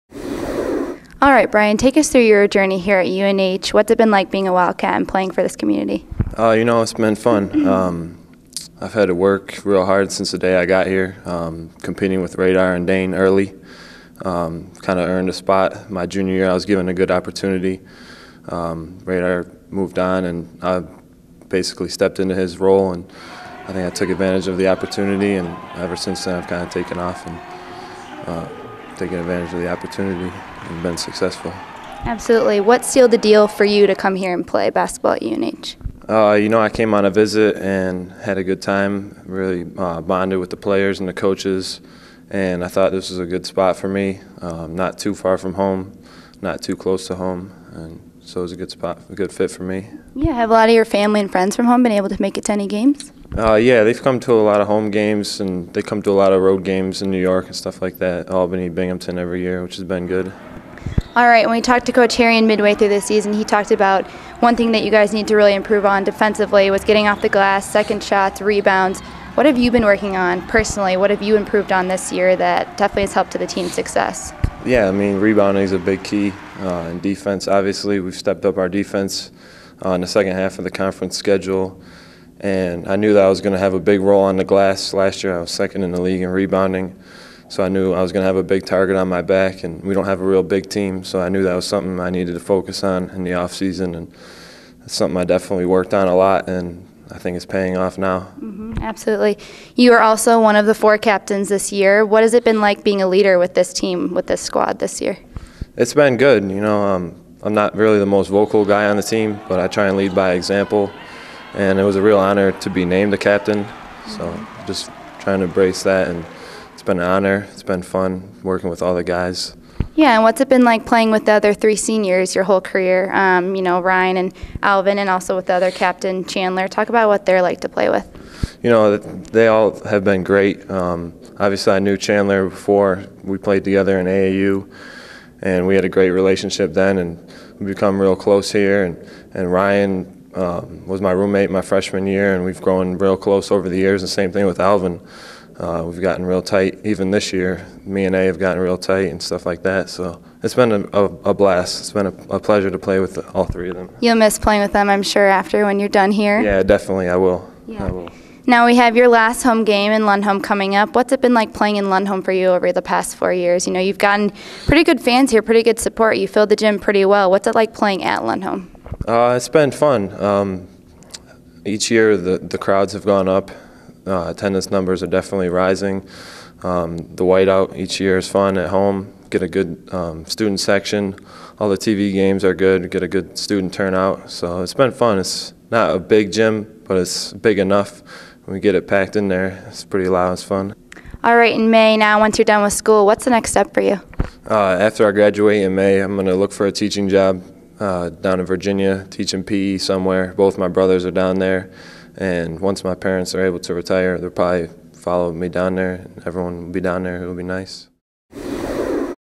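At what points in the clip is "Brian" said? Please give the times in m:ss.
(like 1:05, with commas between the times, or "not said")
0:01.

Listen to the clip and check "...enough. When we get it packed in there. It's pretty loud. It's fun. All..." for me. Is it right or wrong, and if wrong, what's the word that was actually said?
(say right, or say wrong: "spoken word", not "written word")
right.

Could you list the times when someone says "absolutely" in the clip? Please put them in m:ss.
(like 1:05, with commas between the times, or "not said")
0:32, 1:38.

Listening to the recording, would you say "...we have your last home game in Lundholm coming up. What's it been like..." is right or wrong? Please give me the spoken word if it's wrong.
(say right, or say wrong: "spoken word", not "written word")
right.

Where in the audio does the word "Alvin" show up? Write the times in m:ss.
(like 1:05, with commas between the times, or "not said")
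2:04, 2:24.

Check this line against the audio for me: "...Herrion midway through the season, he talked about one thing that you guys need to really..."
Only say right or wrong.
right.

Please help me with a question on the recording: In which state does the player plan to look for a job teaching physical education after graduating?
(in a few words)
Virginia.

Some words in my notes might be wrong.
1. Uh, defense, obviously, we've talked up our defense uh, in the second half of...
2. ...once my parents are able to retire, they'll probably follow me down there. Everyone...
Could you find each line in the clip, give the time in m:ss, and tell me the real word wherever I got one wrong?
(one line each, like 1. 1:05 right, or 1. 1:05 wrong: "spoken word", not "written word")
1. 1:16 wrong: "stepped", not "talked"
2. 3:22 right.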